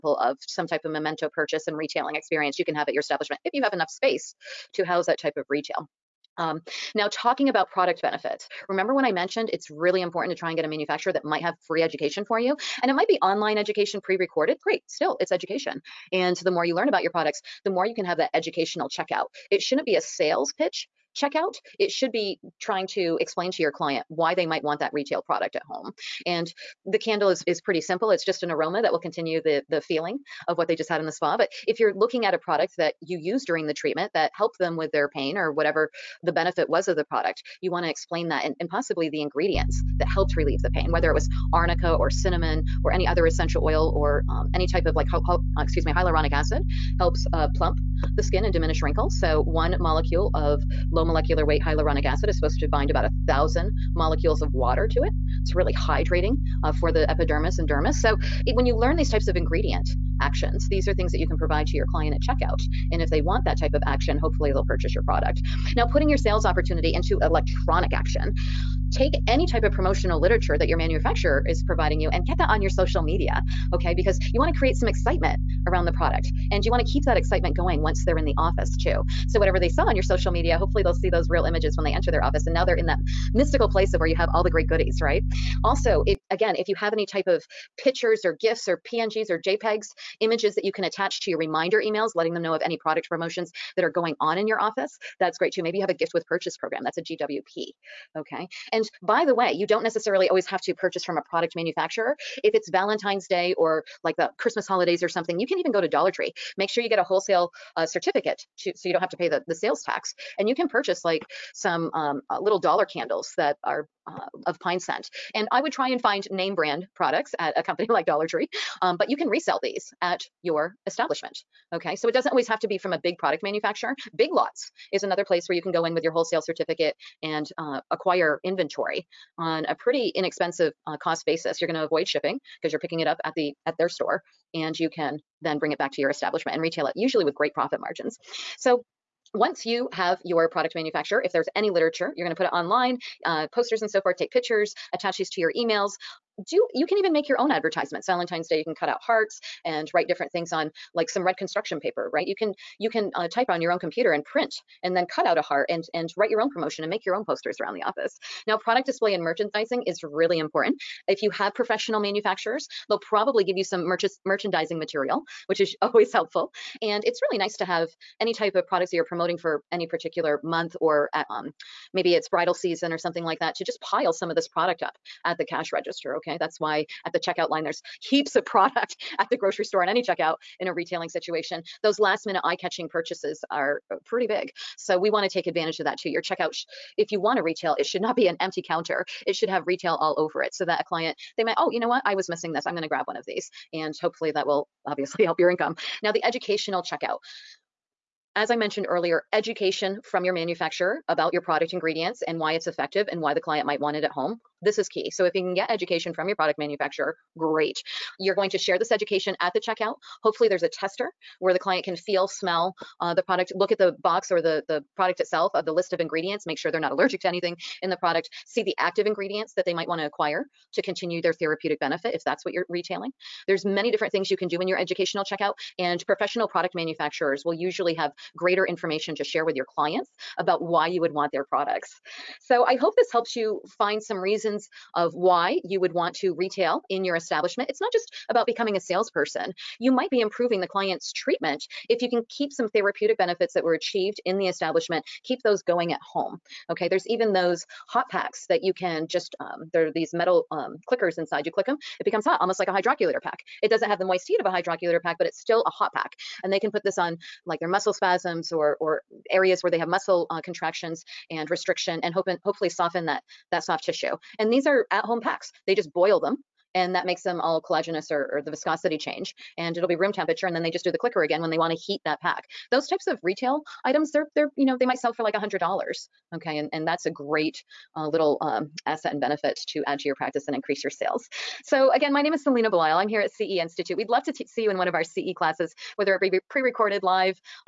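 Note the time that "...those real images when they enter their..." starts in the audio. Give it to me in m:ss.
1:21.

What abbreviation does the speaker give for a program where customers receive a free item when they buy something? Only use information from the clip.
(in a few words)
GWP.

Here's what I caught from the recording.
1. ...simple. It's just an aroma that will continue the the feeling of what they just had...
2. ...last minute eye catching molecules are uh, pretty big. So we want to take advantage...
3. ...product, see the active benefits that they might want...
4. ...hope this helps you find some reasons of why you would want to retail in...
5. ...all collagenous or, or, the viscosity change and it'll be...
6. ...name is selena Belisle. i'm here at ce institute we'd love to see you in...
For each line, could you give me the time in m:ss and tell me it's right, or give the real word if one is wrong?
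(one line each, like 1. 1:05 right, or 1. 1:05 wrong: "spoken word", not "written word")
1. 0:27 right
2. 3:01 wrong: "purchases", not "molecules"
3. 3:38 wrong: "ingredients", not "benefits"
4. 3:52 right
5. 4:27 right
6. 4:42 right.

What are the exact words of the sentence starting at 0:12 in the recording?
And it might be online education pre recorded.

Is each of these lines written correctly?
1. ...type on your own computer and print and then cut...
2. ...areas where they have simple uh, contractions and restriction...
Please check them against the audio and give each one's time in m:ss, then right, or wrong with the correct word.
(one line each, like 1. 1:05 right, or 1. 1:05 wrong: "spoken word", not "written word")
1. 2:33 right
2. 4:19 wrong: "muscle", not "simple".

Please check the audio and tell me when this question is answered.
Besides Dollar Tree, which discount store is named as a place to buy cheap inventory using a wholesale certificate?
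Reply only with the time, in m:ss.
2:04.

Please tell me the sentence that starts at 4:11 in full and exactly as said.
You click them, it becomes hot, almost like a hydrocollator pack.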